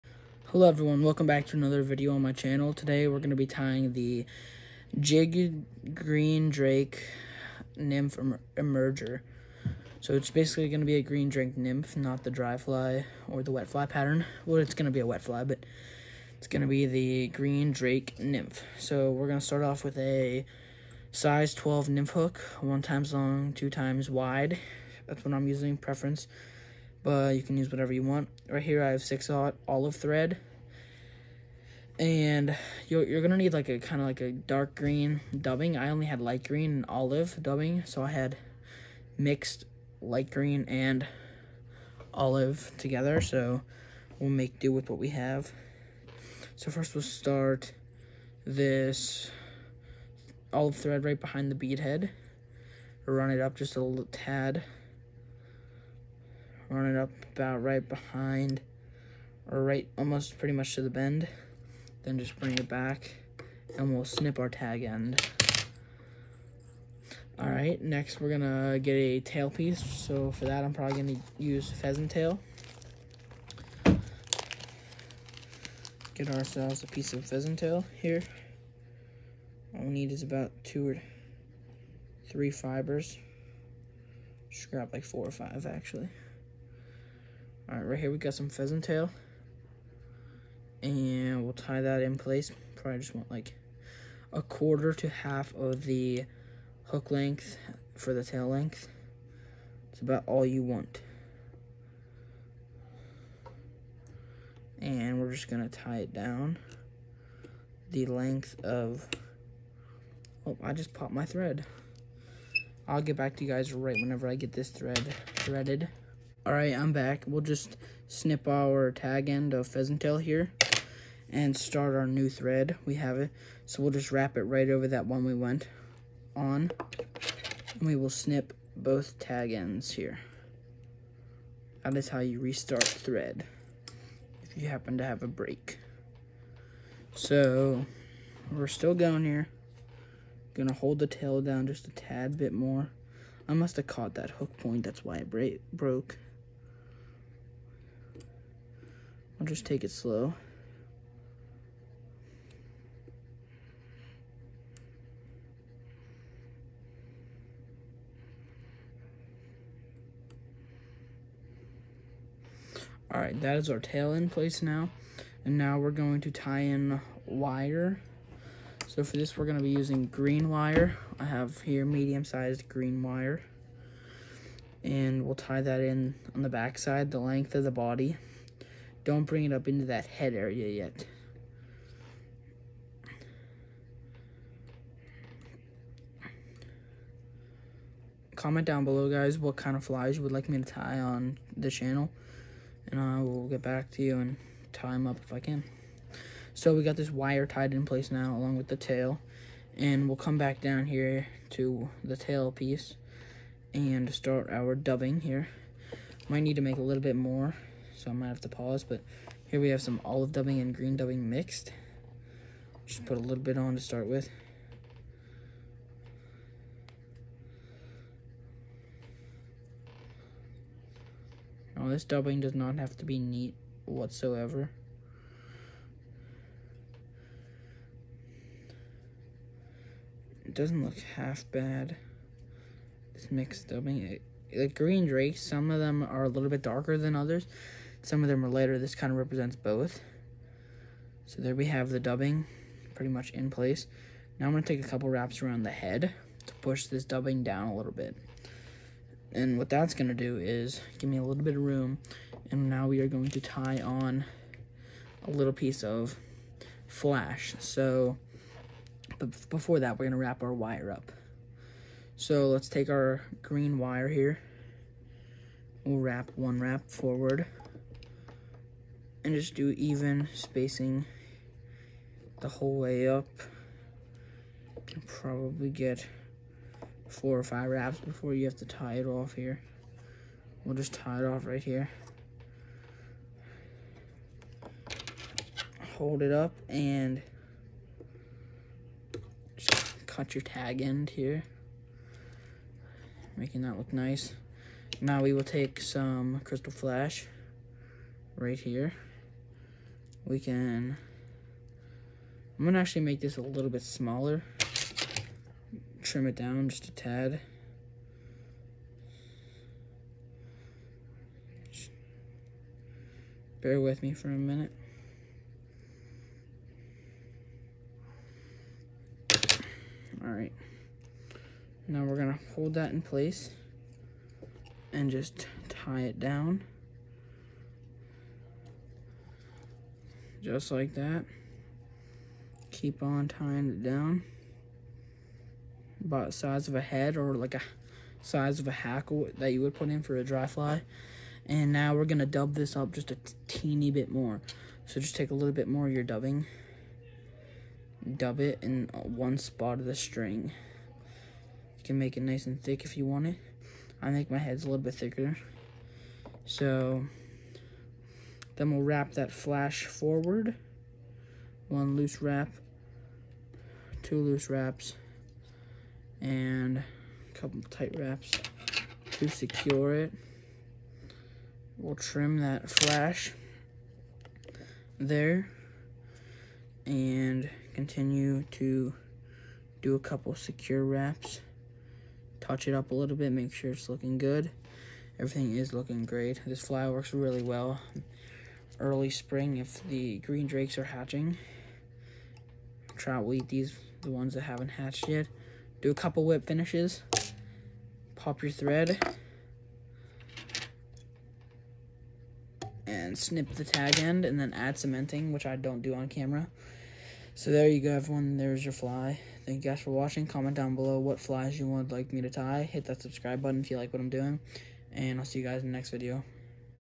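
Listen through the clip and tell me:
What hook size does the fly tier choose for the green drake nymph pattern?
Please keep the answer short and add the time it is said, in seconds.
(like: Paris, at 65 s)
12, at 21 s.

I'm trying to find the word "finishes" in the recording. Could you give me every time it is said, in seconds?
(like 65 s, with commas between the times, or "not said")
396 s.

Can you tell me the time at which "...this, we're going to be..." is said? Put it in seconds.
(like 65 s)
169 s.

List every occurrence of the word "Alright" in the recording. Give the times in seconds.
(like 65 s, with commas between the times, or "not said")
116 s, 163 s.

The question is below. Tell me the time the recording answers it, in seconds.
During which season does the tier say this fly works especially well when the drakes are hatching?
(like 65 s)
388 s.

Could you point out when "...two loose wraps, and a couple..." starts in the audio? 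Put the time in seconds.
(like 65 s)
364 s.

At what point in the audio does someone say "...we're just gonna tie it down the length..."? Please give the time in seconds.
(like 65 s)
105 s.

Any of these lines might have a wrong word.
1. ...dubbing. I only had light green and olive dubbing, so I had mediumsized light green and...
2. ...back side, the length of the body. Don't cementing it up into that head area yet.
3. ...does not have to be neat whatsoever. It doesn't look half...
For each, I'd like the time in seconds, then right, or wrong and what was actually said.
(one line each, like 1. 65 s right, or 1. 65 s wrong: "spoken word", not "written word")
1. 35 s wrong: "mixed", not "mediumsized"
2. 176 s wrong: "bring", not "cementing"
3. 222 s right.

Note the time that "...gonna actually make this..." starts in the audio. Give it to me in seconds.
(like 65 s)
302 s.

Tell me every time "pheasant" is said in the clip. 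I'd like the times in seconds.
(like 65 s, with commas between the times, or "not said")
71 s, 77 s, 88 s, 119 s.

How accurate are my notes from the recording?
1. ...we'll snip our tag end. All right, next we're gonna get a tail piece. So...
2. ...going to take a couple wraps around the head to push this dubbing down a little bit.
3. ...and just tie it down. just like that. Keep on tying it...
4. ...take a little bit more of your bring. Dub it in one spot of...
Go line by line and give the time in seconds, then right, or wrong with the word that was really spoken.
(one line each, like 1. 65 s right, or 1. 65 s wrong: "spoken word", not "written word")
1. 63 s right
2. 244 s right
3. 324 s right
4. 345 s wrong: "dubbing", not "bring".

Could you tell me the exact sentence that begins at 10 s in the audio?
So it's basically going to be a green drake nymph, not the dry fly or the wet fly pattern.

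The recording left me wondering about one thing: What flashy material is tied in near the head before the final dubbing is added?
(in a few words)
Crystal flash.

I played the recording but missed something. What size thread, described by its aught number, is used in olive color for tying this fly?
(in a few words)
6-aught.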